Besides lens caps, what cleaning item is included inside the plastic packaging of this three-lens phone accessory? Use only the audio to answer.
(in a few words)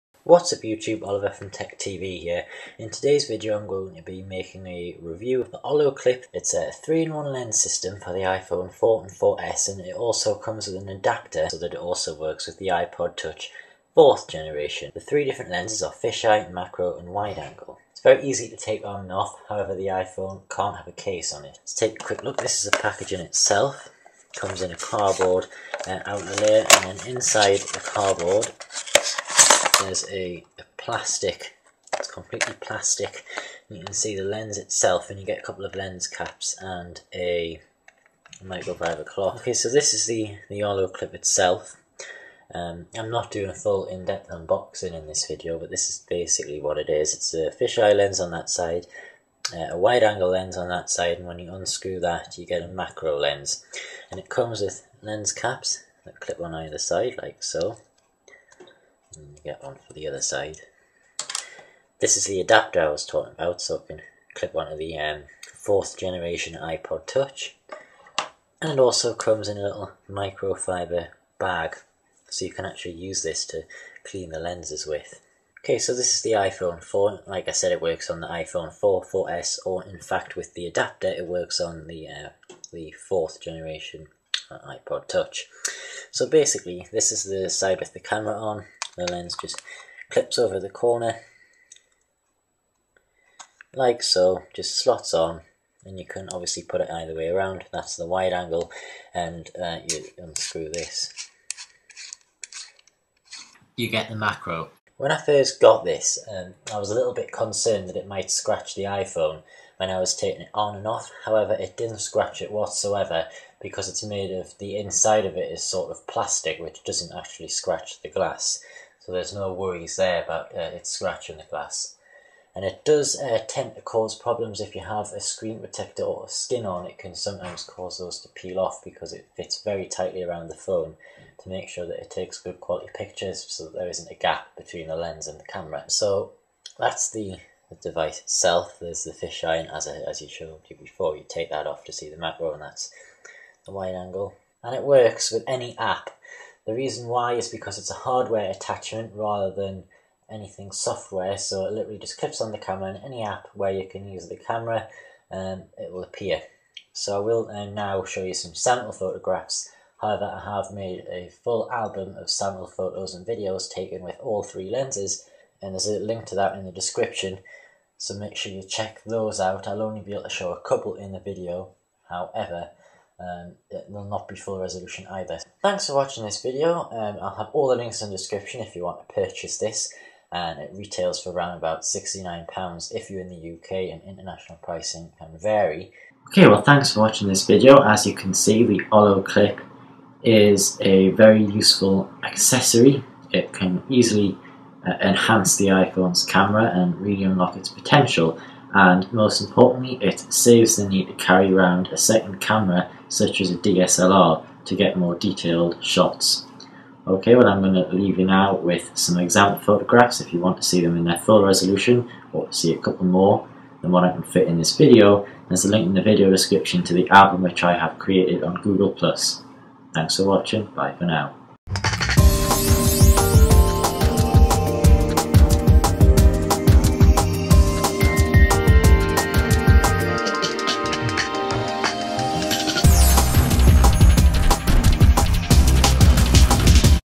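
Microfiber cloth.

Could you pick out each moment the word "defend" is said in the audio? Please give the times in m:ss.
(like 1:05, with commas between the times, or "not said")
not said.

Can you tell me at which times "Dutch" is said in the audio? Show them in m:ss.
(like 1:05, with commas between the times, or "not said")
not said.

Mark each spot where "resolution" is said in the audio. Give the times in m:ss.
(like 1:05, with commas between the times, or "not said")
2:54, 3:31.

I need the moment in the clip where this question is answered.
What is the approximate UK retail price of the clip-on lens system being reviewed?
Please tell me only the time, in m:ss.
3:01.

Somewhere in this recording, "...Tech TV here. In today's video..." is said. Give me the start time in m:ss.
0:01.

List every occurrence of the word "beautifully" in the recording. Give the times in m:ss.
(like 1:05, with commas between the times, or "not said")
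not said.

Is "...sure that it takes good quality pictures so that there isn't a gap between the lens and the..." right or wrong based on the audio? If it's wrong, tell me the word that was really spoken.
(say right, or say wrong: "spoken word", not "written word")
right.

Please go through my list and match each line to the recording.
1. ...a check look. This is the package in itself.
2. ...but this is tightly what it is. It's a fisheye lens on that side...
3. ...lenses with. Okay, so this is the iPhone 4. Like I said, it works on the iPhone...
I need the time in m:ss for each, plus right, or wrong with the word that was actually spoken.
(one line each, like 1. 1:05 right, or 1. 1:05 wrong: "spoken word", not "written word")
1. 0:21 wrong: "quick", not "check"
2. 0:45 wrong: "basically", not "tightly"
3. 1:14 right.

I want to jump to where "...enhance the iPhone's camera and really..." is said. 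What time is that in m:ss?
3:15.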